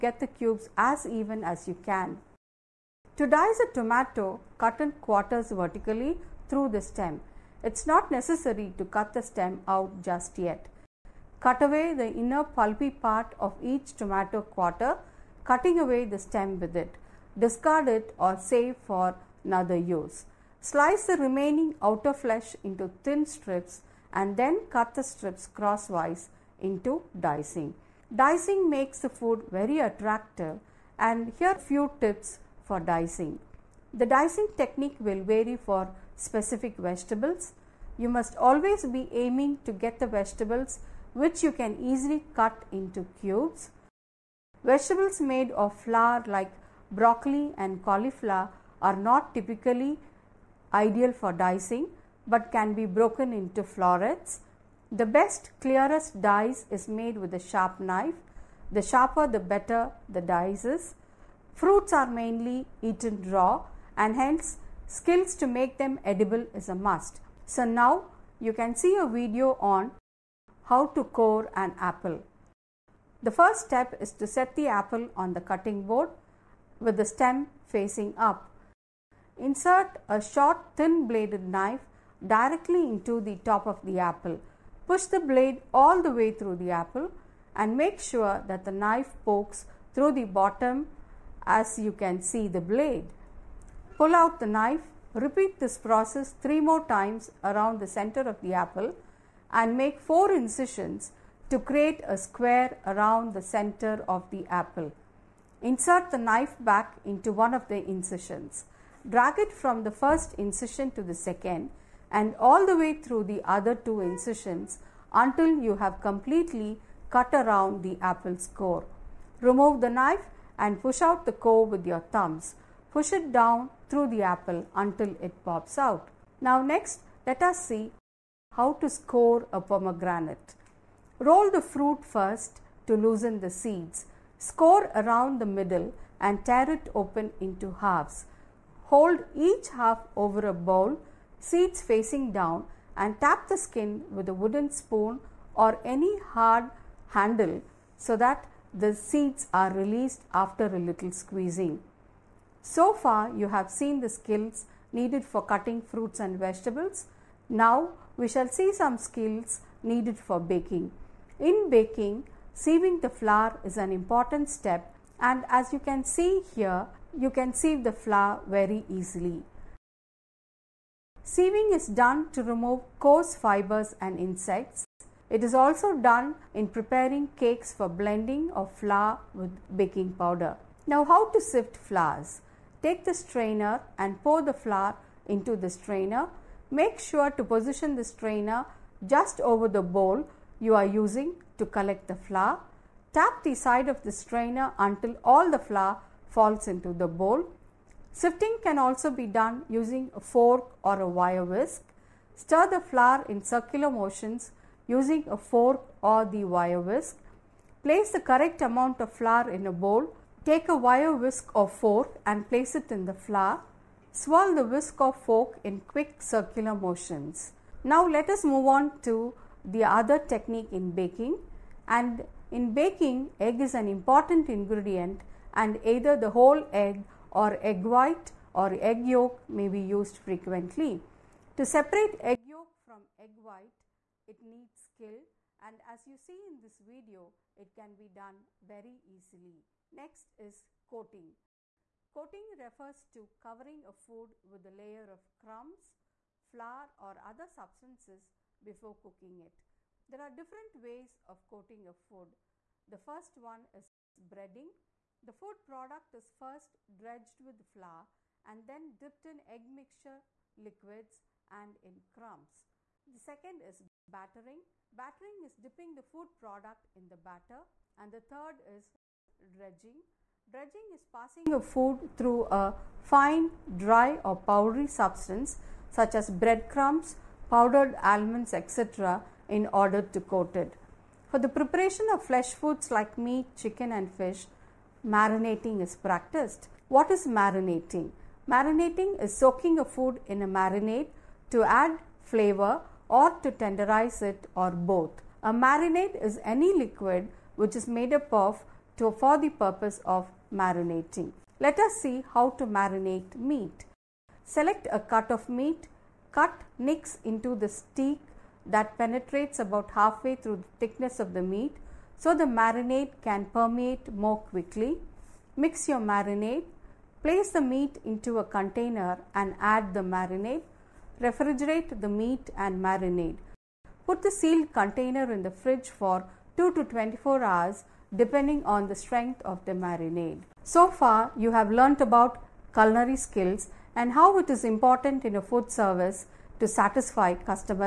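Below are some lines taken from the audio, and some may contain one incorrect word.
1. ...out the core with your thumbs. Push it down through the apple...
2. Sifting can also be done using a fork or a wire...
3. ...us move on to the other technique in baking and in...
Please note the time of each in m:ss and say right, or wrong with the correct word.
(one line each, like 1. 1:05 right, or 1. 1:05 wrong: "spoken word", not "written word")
1. 2:01 right
2. 3:18 right
3. 3:38 right.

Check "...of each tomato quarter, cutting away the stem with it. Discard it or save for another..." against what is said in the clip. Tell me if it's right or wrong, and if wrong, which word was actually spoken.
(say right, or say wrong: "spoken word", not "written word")
right.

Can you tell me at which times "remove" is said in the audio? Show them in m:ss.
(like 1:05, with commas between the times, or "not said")
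1:59, 2:52.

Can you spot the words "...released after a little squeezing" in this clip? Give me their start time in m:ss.
2:29.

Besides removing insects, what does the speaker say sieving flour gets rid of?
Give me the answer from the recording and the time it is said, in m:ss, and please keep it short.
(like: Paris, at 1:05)
coarse fibers, at 2:52.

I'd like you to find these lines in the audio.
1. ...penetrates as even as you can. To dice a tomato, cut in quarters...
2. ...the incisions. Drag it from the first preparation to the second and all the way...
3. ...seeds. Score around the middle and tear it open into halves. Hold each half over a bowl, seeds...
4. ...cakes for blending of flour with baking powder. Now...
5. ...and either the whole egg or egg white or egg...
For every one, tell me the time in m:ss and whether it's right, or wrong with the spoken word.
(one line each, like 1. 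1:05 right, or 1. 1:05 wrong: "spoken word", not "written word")
1. 0:00 wrong: "cubes", not "penetrates"
2. 1:47 wrong: "incision", not "preparation"
3. 2:13 right
4. 2:57 right
5. 3:45 right.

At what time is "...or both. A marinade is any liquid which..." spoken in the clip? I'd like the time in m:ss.
4:54.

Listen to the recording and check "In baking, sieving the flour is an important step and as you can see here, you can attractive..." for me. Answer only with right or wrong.
wrong.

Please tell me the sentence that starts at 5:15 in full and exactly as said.
Mix your marinade, place the meat into a container and add the marinade.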